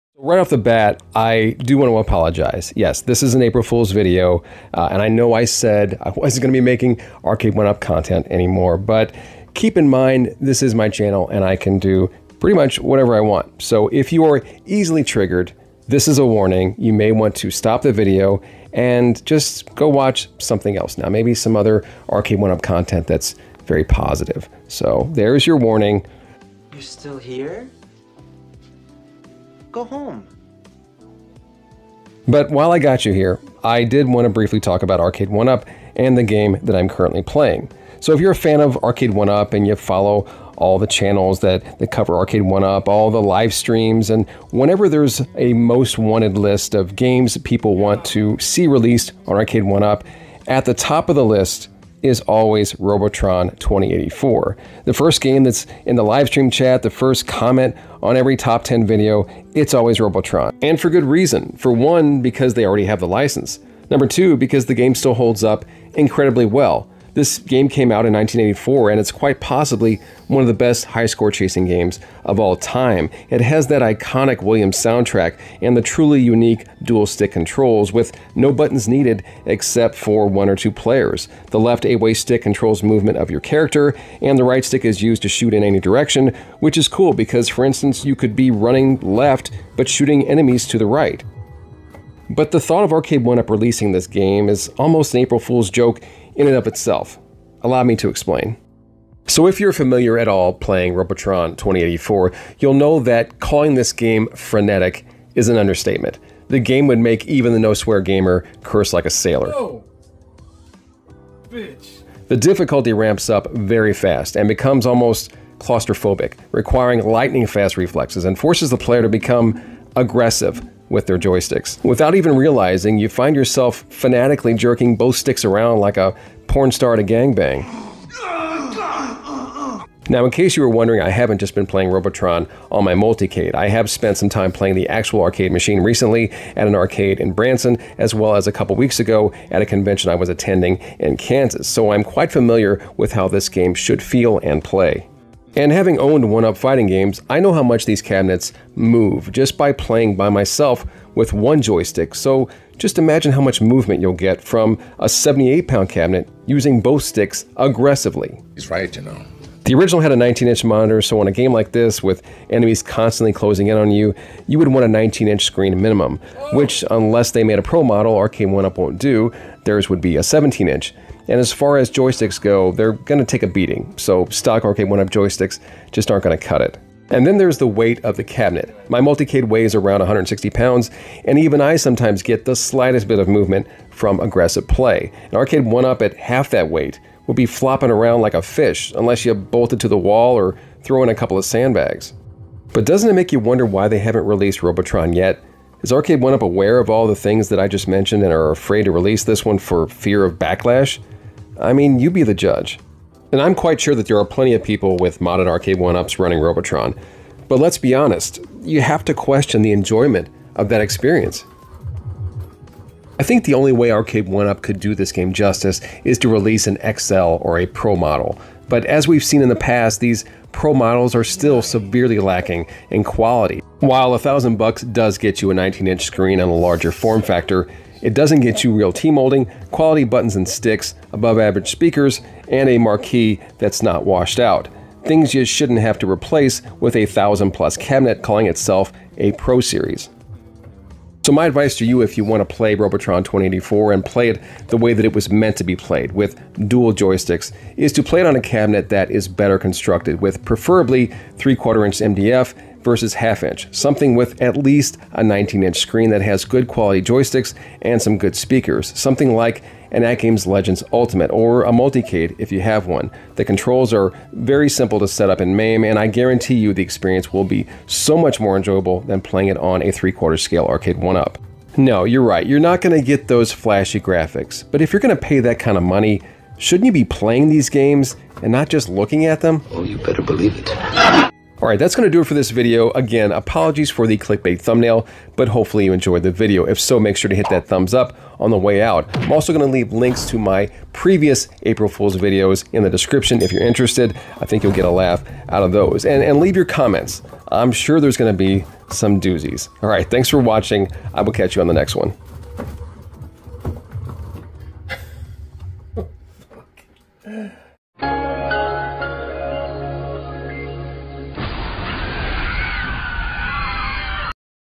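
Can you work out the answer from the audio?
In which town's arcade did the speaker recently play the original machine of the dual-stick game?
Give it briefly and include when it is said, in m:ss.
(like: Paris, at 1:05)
Branson, at 2:17.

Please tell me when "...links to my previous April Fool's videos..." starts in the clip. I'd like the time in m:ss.
4:49.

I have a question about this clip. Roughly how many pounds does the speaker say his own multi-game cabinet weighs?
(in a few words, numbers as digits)
160 pounds.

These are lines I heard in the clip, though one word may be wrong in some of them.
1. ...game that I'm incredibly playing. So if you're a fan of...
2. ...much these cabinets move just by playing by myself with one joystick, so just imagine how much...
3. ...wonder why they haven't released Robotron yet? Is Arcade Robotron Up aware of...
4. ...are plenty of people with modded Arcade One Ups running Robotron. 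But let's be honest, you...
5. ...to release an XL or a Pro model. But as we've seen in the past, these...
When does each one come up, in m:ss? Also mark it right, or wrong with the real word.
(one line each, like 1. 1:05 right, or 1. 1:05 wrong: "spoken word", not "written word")
1. 0:36 wrong: "currently", not "incredibly"
2. 2:27 right
3. 3:13 wrong: "One", not "Robotron"
4. 3:24 right
5. 3:36 right.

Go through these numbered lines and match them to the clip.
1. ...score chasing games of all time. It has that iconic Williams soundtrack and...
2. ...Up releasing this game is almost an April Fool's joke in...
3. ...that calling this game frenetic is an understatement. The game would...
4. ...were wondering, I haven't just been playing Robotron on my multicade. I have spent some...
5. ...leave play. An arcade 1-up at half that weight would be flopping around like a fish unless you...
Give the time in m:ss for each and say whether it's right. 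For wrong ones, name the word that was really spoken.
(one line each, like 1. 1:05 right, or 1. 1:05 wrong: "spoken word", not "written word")
1. 1:11 right
2. 1:33 right
3. 1:43 right
4. 2:10 right
5. 3:04 wrong: "aggressive", not "leave".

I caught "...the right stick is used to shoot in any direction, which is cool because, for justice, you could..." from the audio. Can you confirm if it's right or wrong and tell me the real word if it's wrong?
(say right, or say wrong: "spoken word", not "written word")
wrong: "instance", not "justice".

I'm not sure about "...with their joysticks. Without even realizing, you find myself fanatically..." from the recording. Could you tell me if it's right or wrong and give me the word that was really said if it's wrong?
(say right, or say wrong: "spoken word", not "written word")
wrong: "yourself", not "myself".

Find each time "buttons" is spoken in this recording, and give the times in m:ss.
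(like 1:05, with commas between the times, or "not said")
1:18, 3:50.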